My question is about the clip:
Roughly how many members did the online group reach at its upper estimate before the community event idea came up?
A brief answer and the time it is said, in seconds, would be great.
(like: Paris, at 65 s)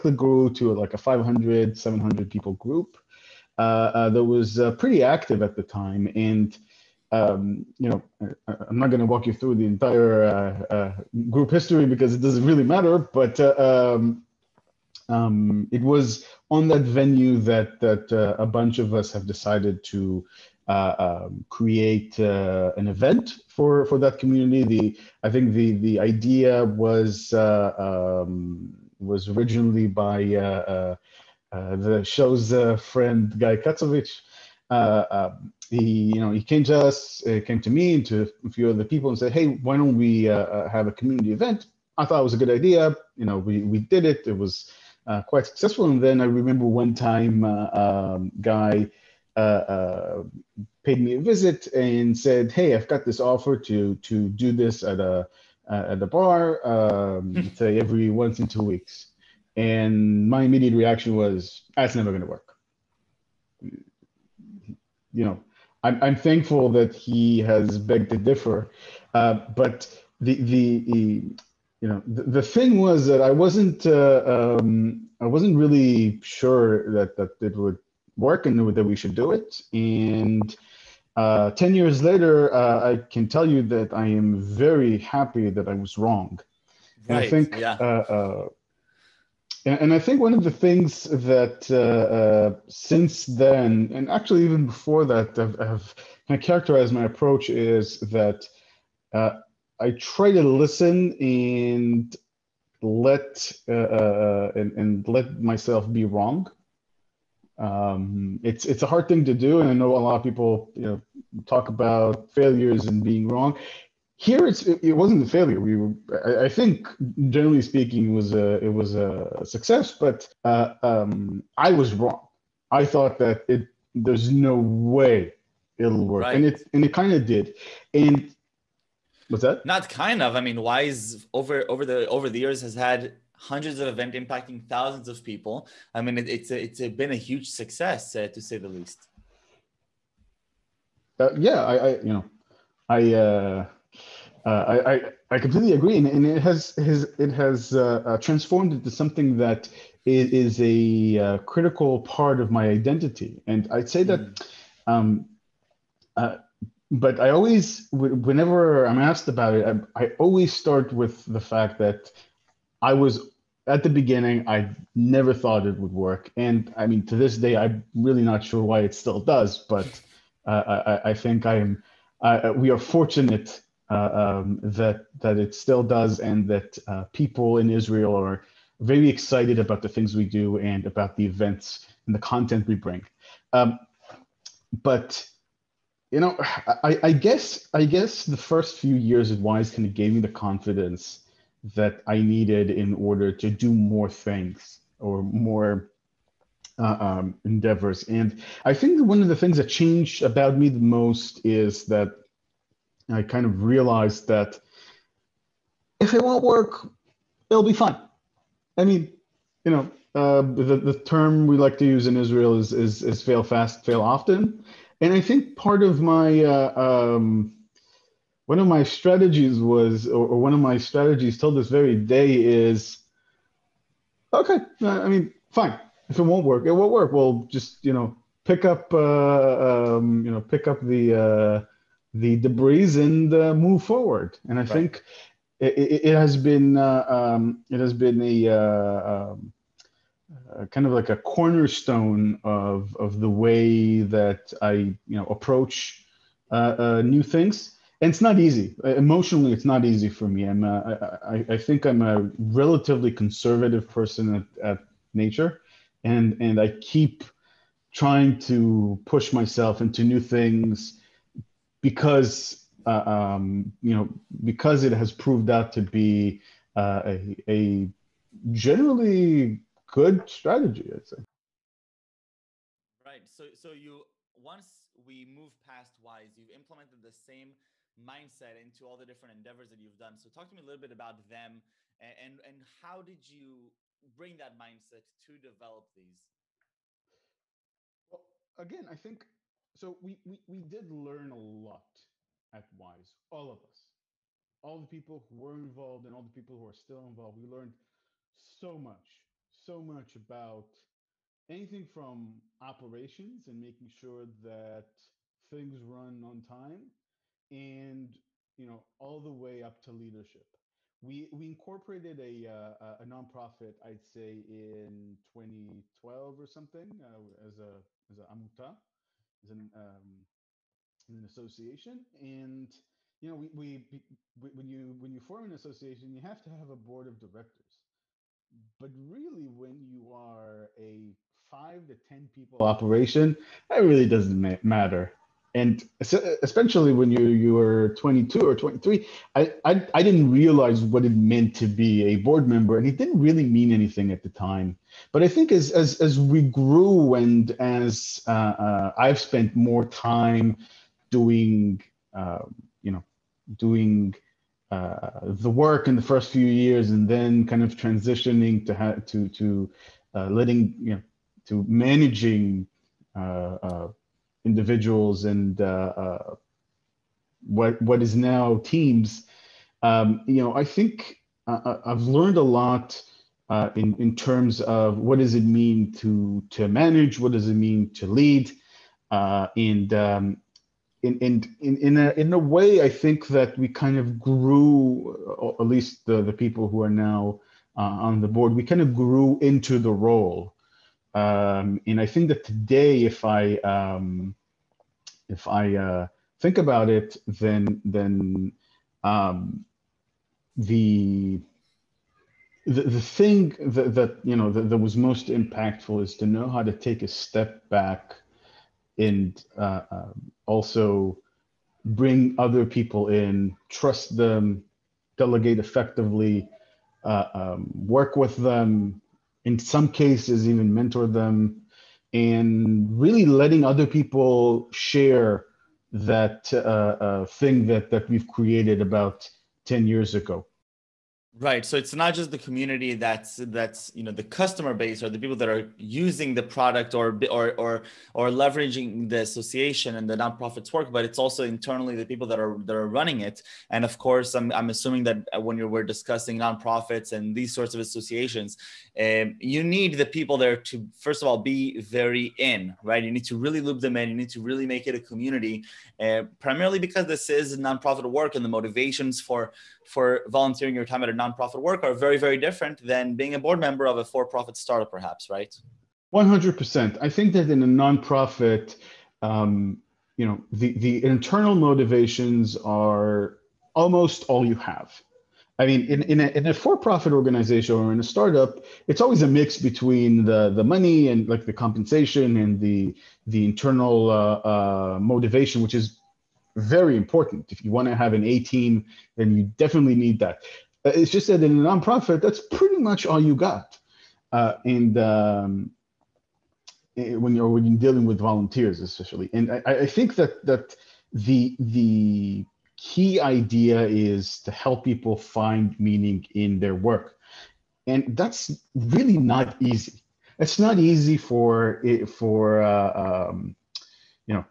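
700, at 1 s.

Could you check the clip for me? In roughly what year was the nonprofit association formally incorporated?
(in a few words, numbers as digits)
2012.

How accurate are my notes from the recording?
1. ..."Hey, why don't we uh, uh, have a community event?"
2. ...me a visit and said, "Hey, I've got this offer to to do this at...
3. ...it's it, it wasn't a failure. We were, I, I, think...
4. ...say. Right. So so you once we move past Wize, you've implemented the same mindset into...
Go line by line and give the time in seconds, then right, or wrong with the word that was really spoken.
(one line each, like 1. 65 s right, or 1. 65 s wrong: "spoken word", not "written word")
1. 39 s right
2. 51 s right
3. 114 s right
4. 271 s right.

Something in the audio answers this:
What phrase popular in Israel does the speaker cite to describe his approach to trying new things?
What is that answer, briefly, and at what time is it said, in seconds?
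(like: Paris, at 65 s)
Fail fast, fail often, at 213 s.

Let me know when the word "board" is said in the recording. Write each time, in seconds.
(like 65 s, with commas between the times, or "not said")
326 s, 342 s, 388 s, 463 s.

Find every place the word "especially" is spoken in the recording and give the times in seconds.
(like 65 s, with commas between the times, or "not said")
336 s, 498 s.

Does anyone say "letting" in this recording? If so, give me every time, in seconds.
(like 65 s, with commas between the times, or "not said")
360 s, 423 s.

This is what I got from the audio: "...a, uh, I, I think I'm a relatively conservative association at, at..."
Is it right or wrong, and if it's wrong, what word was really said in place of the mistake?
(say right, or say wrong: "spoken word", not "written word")
wrong: "person", not "association".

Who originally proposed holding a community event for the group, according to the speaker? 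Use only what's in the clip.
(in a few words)
Guy Katsovich.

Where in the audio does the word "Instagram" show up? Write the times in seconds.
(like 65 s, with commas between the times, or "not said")
not said.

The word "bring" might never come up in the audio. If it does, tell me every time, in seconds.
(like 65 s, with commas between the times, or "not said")
182 s, 284 s, 411 s.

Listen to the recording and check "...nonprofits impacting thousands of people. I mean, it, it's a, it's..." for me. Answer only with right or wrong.
wrong.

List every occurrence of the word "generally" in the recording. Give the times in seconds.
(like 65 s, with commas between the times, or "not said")
117 s, 268 s.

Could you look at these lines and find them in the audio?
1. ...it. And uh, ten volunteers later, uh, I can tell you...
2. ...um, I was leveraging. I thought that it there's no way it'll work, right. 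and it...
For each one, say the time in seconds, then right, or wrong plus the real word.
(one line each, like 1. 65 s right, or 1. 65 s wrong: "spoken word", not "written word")
1. 79 s wrong: "years", not "volunteers"
2. 120 s wrong: "wrong", not "leveraging".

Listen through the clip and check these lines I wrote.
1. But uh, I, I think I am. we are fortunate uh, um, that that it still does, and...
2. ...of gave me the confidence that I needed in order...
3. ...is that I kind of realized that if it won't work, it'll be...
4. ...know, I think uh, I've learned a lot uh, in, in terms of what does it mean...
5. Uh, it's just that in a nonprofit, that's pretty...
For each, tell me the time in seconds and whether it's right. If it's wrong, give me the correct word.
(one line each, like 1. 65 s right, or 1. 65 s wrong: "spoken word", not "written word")
1. 169 s right
2. 189 s right
3. 201 s right
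4. 370 s right
5. 490 s right.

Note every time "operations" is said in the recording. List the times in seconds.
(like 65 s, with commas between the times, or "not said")
302 s, 332 s.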